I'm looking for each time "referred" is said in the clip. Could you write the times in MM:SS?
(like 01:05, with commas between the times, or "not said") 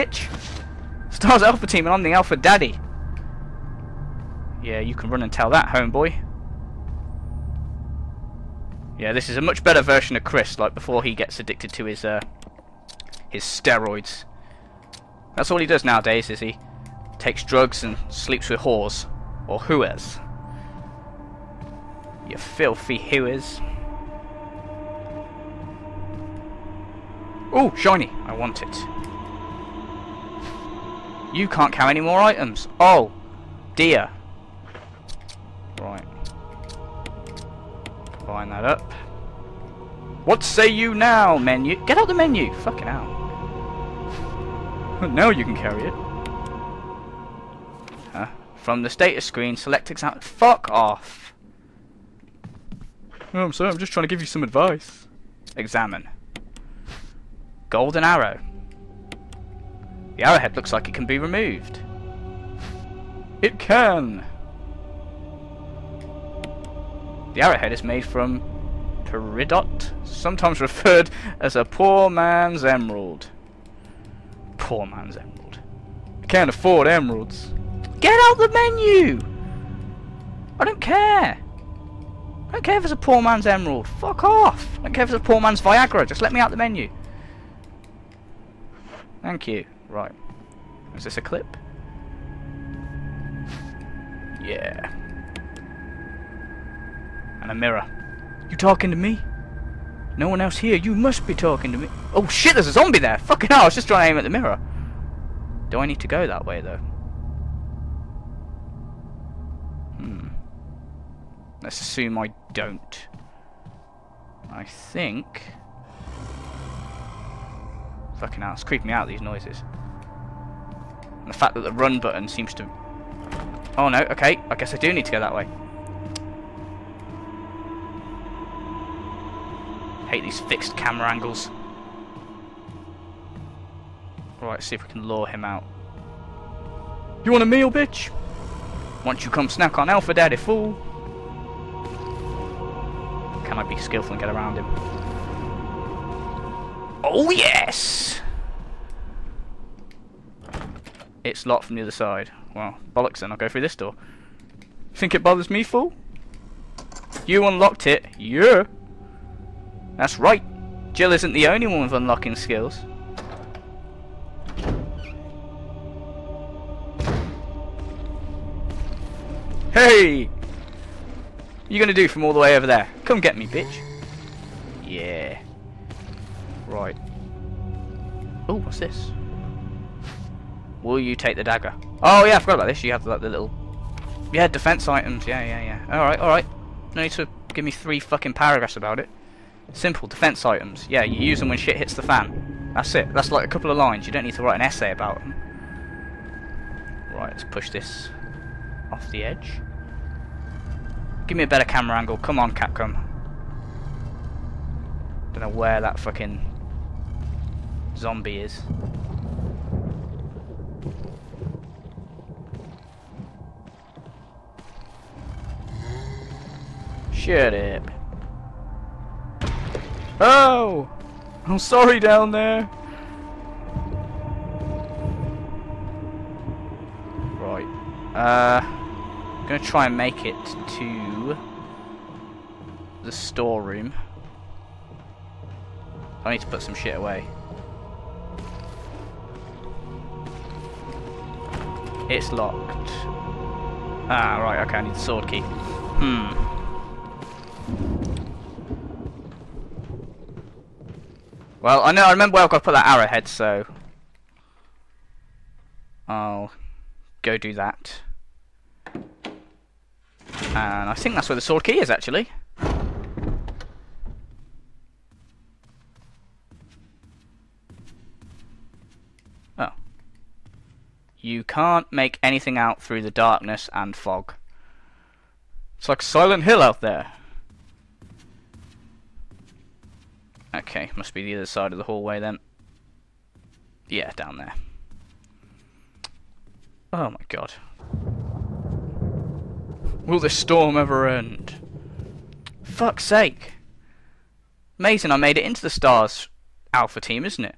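01:10.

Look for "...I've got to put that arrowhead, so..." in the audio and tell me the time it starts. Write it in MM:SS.
04:12.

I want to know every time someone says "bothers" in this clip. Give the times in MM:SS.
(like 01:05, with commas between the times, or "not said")
02:35.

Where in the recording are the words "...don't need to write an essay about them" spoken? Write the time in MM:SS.
03:14.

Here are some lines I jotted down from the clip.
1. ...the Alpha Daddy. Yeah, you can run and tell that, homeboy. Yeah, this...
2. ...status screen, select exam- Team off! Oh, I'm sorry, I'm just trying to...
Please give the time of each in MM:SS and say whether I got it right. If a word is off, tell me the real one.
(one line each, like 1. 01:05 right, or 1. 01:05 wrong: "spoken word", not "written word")
1. 00:02 right
2. 00:48 wrong: "Fuck", not "Team".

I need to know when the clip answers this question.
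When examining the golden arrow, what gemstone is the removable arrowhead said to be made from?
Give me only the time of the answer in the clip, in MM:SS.
01:09.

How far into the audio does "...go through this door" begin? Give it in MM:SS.
02:33.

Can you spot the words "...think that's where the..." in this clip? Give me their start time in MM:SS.
04:20.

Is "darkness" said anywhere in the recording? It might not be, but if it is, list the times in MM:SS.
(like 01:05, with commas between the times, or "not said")
04:33.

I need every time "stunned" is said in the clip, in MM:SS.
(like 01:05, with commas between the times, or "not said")
not said.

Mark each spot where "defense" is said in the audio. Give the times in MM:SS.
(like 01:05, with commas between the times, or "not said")
03:04, 03:10.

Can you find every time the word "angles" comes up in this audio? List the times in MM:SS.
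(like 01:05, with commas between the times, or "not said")
02:11, 03:21.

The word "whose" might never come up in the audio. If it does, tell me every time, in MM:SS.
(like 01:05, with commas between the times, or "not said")
not said.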